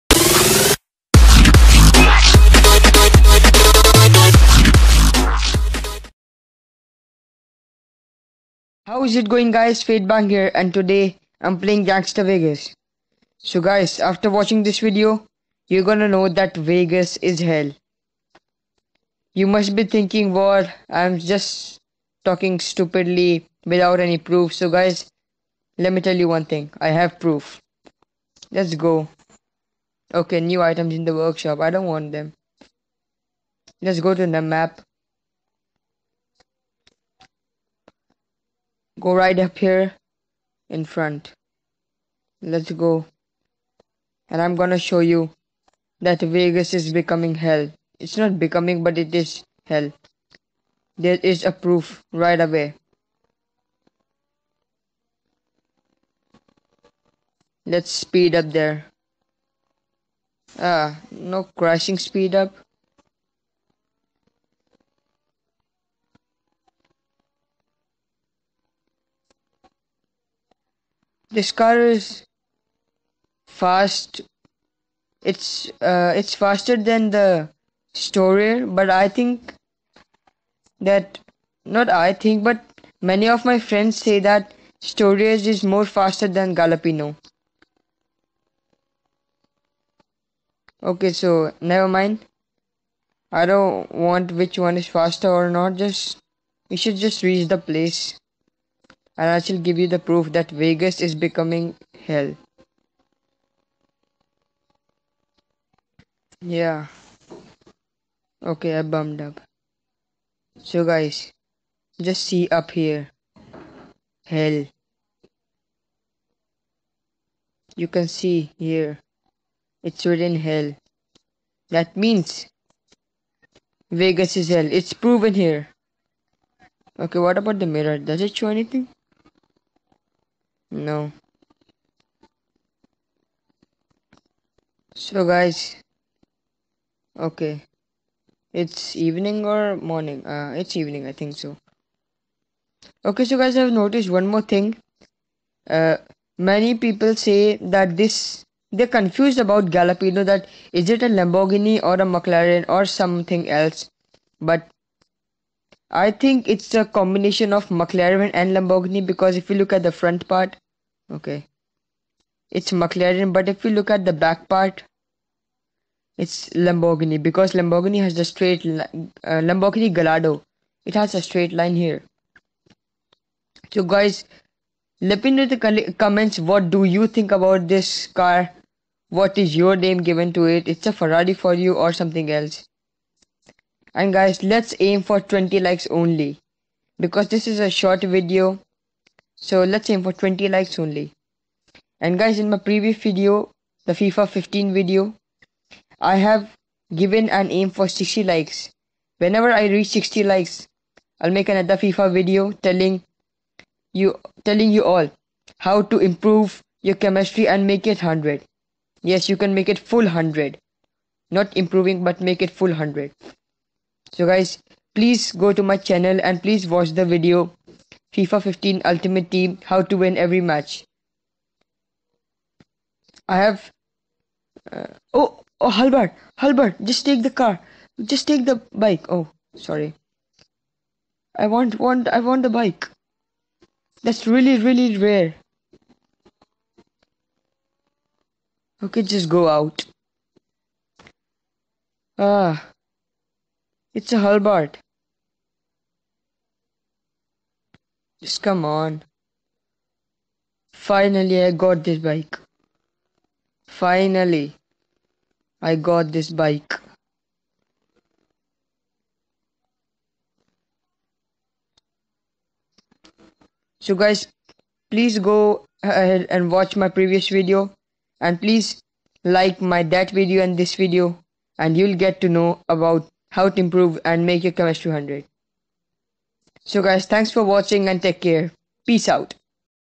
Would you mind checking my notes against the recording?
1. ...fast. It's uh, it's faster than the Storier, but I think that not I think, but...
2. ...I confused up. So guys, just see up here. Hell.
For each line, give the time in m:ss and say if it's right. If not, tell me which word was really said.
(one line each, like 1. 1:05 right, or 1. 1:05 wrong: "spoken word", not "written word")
1. 1:13 right
2. 1:48 wrong: "bummed", not "confused".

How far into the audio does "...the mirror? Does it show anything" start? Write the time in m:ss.
2:07.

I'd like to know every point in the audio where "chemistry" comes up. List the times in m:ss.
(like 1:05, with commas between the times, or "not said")
3:26, 4:34.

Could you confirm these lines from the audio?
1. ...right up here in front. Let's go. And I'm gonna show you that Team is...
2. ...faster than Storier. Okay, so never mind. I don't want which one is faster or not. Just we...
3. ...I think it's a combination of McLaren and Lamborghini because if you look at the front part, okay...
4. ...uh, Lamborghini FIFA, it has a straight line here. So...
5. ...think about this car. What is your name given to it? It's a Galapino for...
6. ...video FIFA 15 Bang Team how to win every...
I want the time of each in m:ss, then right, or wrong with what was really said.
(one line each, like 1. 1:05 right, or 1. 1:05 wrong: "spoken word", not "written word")
1. 0:39 wrong: "Vegas", not "Team"
2. 1:25 wrong: "Galapino", not "Storier"
3. 2:35 right
4. 2:48 wrong: "Gallardo", not "FIFA"
5. 2:57 wrong: "Ferrari", not "Galapino"
6. 3:37 wrong: "Ultimate", not "Bang".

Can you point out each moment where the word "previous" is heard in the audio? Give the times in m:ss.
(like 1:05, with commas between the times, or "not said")
3:12, 4:26.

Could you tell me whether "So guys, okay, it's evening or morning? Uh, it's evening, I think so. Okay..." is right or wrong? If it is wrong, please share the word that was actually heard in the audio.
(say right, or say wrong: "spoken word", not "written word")
right.